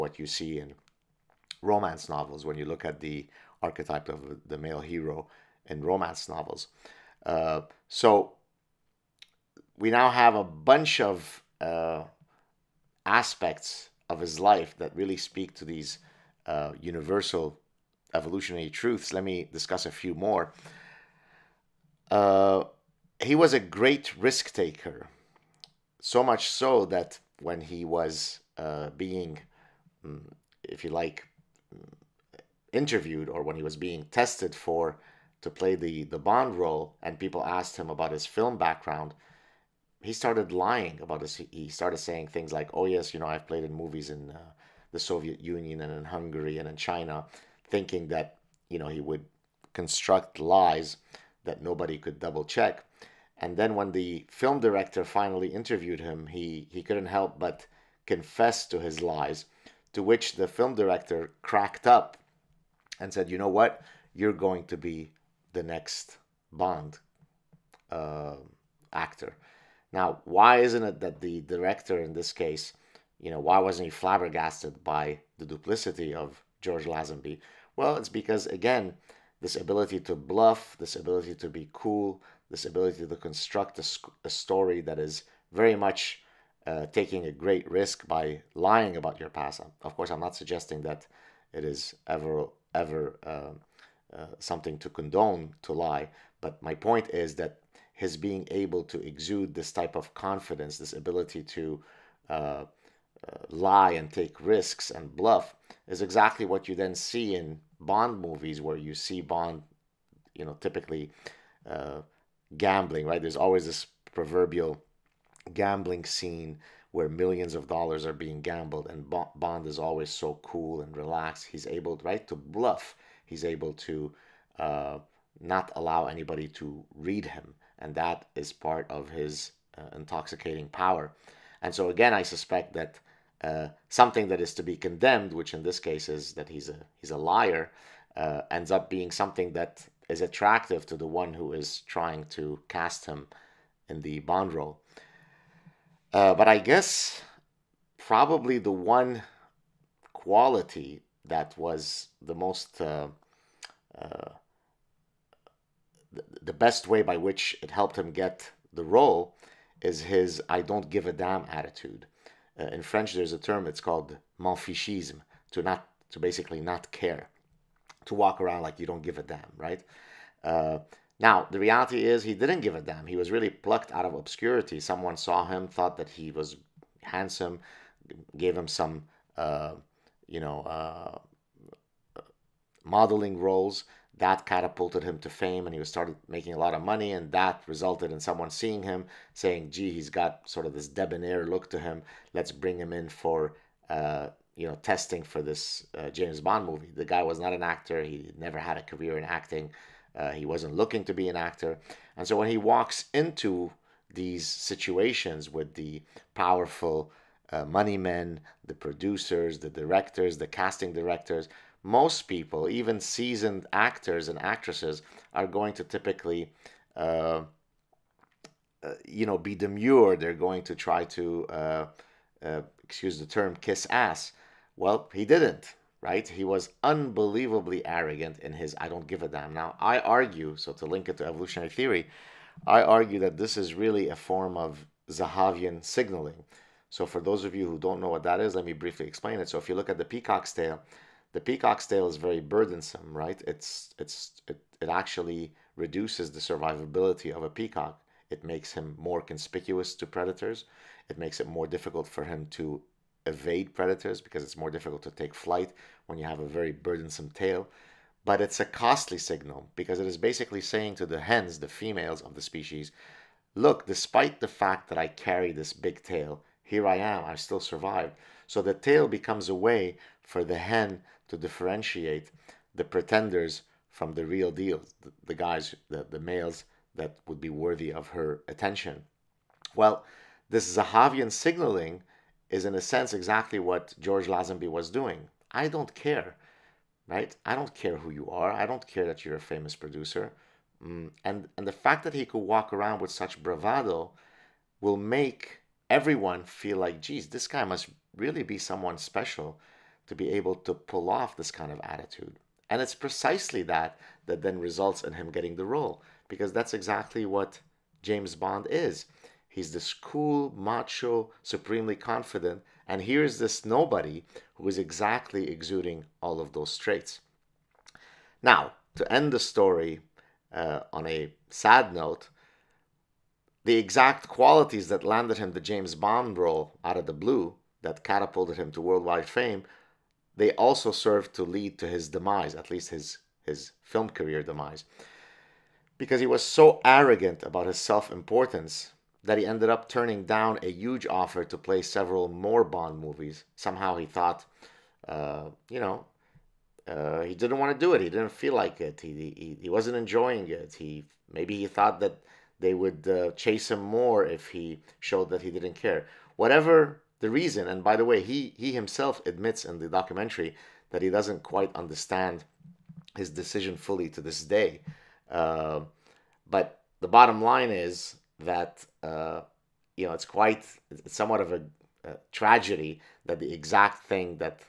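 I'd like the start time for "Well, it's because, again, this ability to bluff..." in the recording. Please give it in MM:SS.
01:17.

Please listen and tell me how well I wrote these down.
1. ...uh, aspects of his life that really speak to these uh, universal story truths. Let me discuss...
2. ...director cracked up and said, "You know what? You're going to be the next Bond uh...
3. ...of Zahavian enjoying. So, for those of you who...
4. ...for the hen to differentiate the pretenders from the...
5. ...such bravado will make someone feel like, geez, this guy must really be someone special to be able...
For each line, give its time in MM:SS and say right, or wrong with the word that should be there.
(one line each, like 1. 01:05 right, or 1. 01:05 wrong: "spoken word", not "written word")
1. 00:11 wrong: "evolutionary", not "story"
2. 01:00 right
3. 03:54 wrong: "signaling", not "enjoying"
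4. 04:30 right
5. 04:53 wrong: "everyone", not "someone".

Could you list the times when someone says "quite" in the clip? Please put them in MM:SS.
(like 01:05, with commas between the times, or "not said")
06:01, 06:10.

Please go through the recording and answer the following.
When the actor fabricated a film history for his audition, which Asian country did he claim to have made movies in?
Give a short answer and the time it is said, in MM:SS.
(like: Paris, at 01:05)
China, at 00:46.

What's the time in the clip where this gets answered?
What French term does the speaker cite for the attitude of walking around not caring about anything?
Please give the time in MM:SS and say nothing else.
02:44.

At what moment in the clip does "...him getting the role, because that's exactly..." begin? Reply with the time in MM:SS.
05:05.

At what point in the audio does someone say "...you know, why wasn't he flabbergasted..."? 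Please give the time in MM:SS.
01:13.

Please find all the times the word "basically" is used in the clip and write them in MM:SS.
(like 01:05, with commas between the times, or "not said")
02:46, 04:20.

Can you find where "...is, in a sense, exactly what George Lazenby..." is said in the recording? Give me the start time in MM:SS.
04:42.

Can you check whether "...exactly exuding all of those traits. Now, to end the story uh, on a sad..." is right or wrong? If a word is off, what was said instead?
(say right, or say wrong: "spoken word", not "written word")
right.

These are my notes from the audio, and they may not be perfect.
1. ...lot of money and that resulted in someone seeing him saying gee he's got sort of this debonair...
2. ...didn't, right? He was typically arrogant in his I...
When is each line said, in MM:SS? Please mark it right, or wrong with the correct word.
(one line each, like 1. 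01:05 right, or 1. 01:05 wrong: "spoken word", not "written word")
1. 03:06 right
2. 03:45 wrong: "unbelievably", not "typically".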